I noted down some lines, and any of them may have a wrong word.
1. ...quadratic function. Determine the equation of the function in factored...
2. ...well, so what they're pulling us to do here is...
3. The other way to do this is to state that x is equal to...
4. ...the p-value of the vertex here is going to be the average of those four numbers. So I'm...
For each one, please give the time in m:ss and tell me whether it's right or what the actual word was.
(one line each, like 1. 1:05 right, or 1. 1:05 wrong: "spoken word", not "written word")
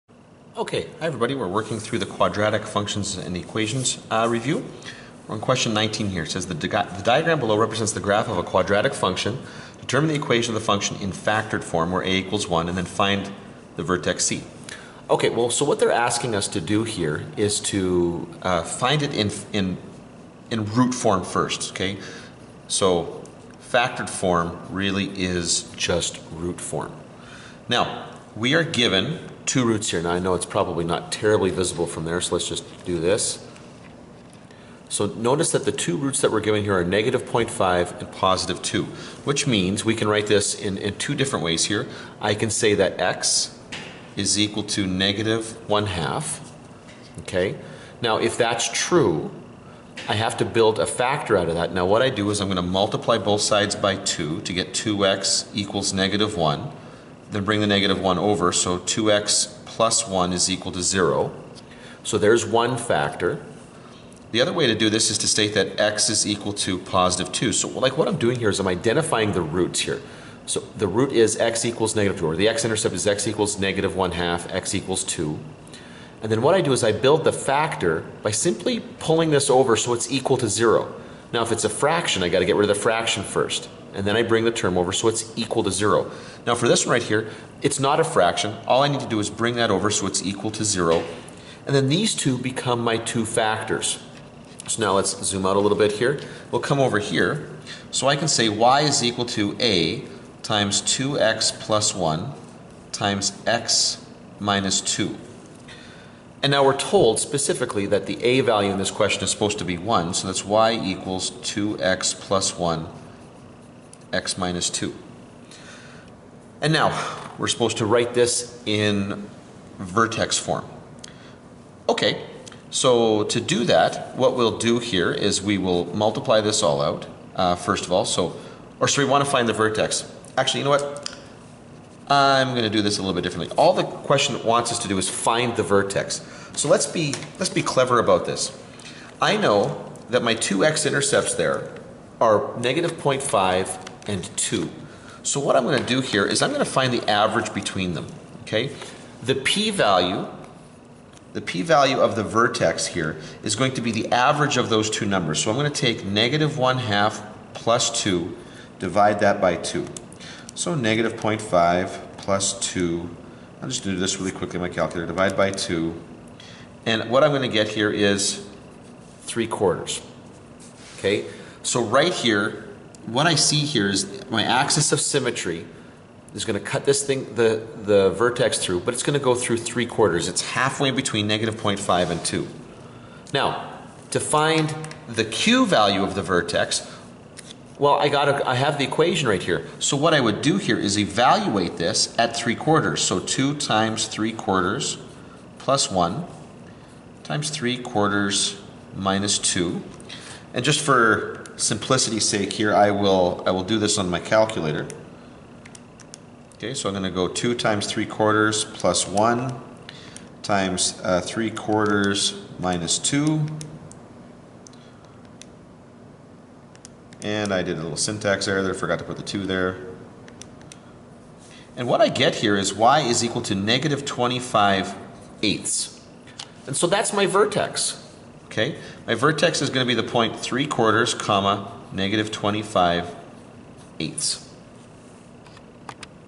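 1. 0:08 right
2. 0:15 wrong: "asking", not "pulling"
3. 1:04 right
4. 2:31 wrong: "two", not "four".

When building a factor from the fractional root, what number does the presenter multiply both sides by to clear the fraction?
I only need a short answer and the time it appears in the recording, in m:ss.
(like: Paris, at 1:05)
2, at 0:52.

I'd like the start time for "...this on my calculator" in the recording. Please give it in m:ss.
3:23.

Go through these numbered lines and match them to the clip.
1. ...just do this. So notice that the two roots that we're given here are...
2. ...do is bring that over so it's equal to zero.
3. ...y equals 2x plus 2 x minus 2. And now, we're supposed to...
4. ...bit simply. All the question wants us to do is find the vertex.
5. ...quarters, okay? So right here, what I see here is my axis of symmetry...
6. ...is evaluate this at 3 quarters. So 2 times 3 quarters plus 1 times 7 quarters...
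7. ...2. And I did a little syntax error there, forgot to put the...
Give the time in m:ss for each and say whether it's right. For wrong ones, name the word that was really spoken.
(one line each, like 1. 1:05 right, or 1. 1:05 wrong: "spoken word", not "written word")
1. 0:32 right
2. 1:29 right
3. 1:50 wrong: "1", not "2"
4. 2:13 wrong: "differently", not "simply"
5. 2:49 right
6. 3:10 wrong: "3", not "7"
7. 3:32 right.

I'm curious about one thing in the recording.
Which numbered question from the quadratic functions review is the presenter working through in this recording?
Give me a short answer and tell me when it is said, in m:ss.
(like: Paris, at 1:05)
19, at 0:05.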